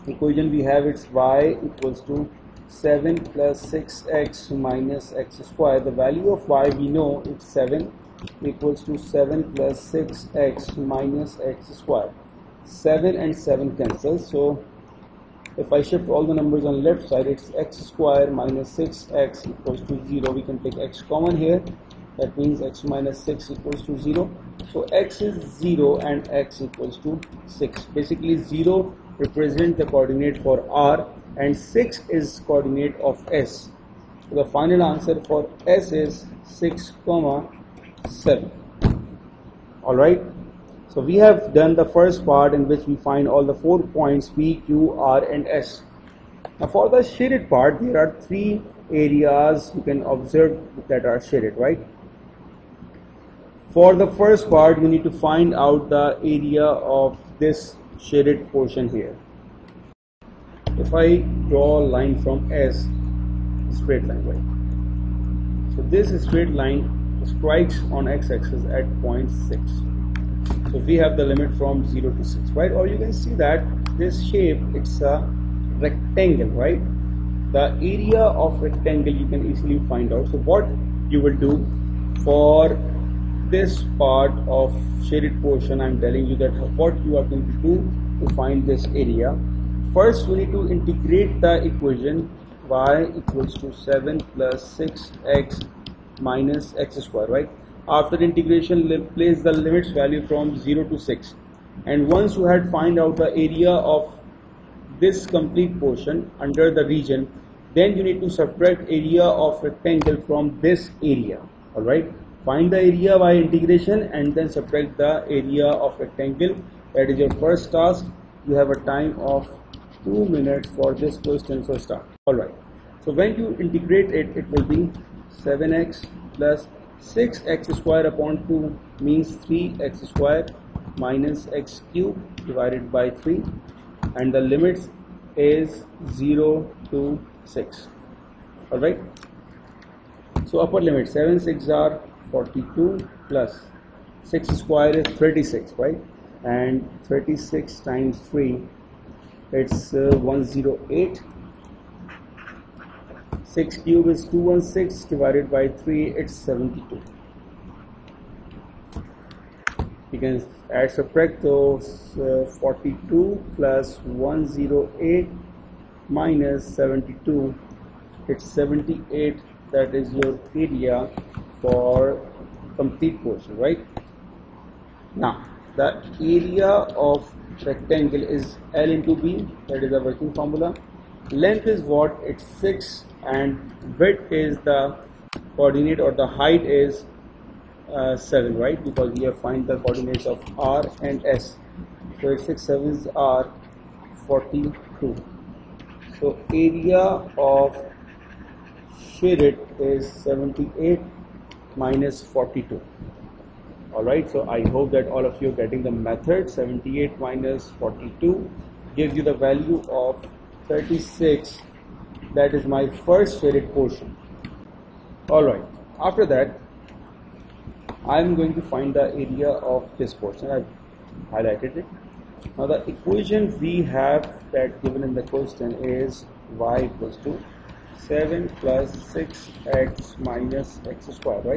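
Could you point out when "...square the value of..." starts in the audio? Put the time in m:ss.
0:05.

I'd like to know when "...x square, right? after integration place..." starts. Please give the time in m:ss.
1:36.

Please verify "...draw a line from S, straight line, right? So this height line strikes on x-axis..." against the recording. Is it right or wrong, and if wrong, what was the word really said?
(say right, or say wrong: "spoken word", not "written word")
wrong: "straight", not "height".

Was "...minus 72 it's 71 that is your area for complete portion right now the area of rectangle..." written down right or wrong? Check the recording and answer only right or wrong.
wrong.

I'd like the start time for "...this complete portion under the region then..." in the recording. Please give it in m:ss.
1:44.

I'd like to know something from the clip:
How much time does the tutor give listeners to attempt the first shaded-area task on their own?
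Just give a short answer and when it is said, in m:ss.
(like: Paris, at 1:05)
2 minutes, at 2:00.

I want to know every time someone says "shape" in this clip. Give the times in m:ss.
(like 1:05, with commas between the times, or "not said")
1:14.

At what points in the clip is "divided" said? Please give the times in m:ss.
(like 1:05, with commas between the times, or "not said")
2:12, 2:35.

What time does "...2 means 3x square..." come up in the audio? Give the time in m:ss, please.
2:08.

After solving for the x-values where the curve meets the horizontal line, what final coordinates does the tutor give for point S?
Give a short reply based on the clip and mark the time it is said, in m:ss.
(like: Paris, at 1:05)
(6, 7), at 0:36.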